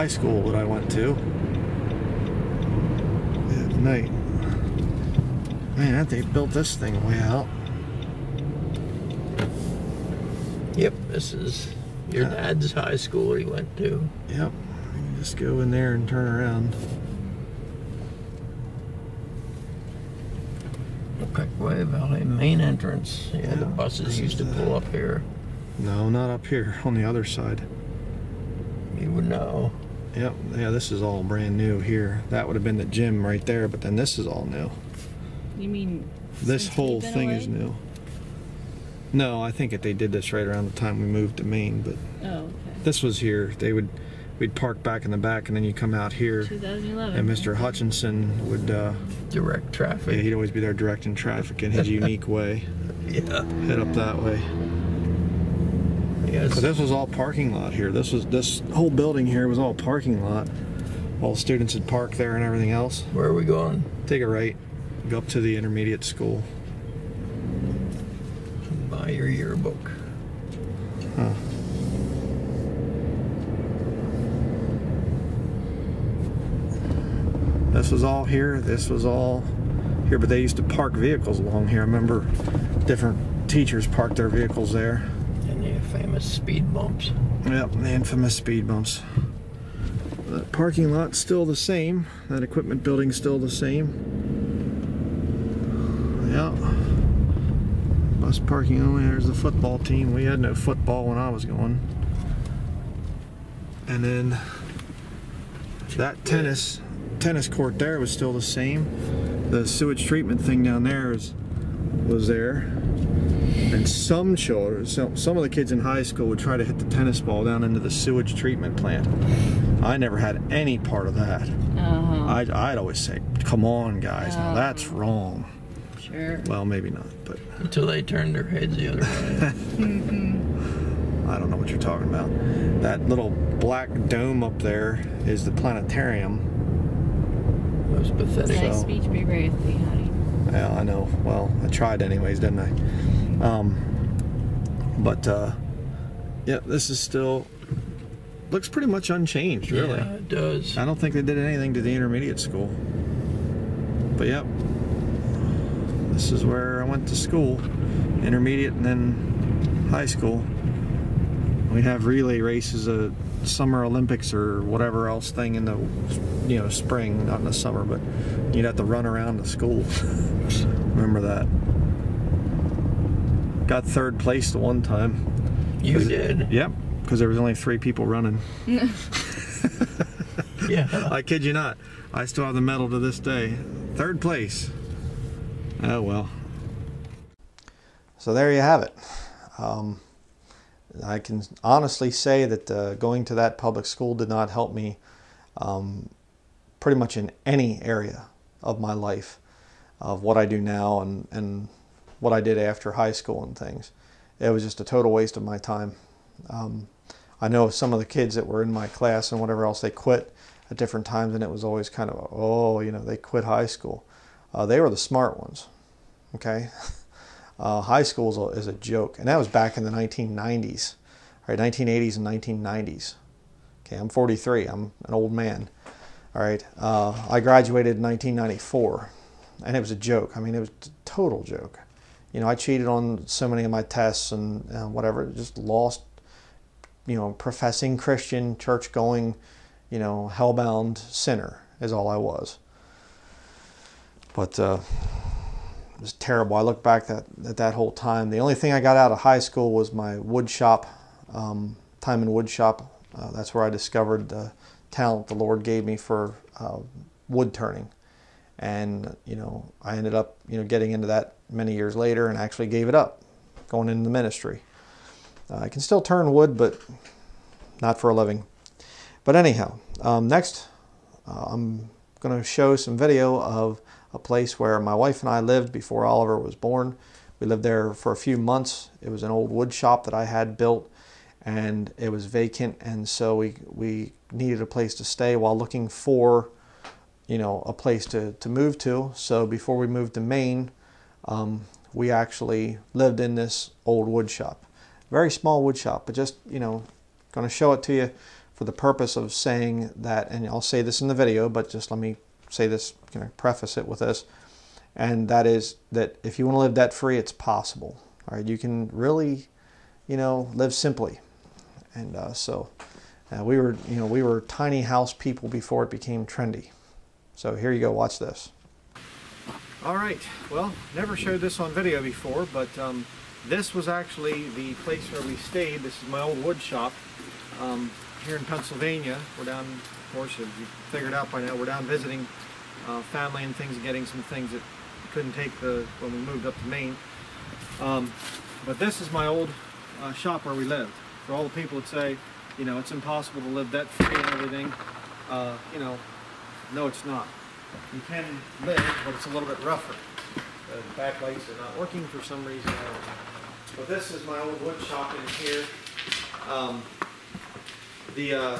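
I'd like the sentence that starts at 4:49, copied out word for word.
So before we moved to Maine, um, we actually lived in this old wood shop.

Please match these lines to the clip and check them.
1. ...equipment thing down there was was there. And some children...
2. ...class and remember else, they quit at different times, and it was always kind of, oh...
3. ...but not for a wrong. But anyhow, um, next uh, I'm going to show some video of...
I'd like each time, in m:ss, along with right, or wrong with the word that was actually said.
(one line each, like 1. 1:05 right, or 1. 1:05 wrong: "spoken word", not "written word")
1. 1:50 wrong: "treatment", not "equipment"
2. 3:28 wrong: "whatever", not "remember"
3. 4:26 wrong: "living", not "wrong".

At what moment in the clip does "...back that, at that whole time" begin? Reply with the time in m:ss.
4:06.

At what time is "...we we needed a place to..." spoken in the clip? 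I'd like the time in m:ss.
4:43.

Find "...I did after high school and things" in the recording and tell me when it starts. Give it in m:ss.
3:22.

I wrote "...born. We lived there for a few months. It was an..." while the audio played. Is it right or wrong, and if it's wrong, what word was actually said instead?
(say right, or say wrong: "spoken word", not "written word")
right.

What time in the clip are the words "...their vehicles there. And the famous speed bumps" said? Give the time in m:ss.
1:24.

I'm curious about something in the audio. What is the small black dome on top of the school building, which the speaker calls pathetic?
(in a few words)
The planetarium.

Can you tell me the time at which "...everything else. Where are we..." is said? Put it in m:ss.
1:02.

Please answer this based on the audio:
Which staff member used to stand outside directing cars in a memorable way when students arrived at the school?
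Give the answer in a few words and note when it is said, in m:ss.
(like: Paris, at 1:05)
Mr. Hutchinson, at 0:47.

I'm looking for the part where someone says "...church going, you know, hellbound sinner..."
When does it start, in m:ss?
3:58.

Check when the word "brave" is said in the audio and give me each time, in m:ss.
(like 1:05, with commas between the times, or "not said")
2:19.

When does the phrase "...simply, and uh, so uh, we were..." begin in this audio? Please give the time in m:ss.
5:10.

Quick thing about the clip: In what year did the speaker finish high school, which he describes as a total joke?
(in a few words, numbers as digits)
1994.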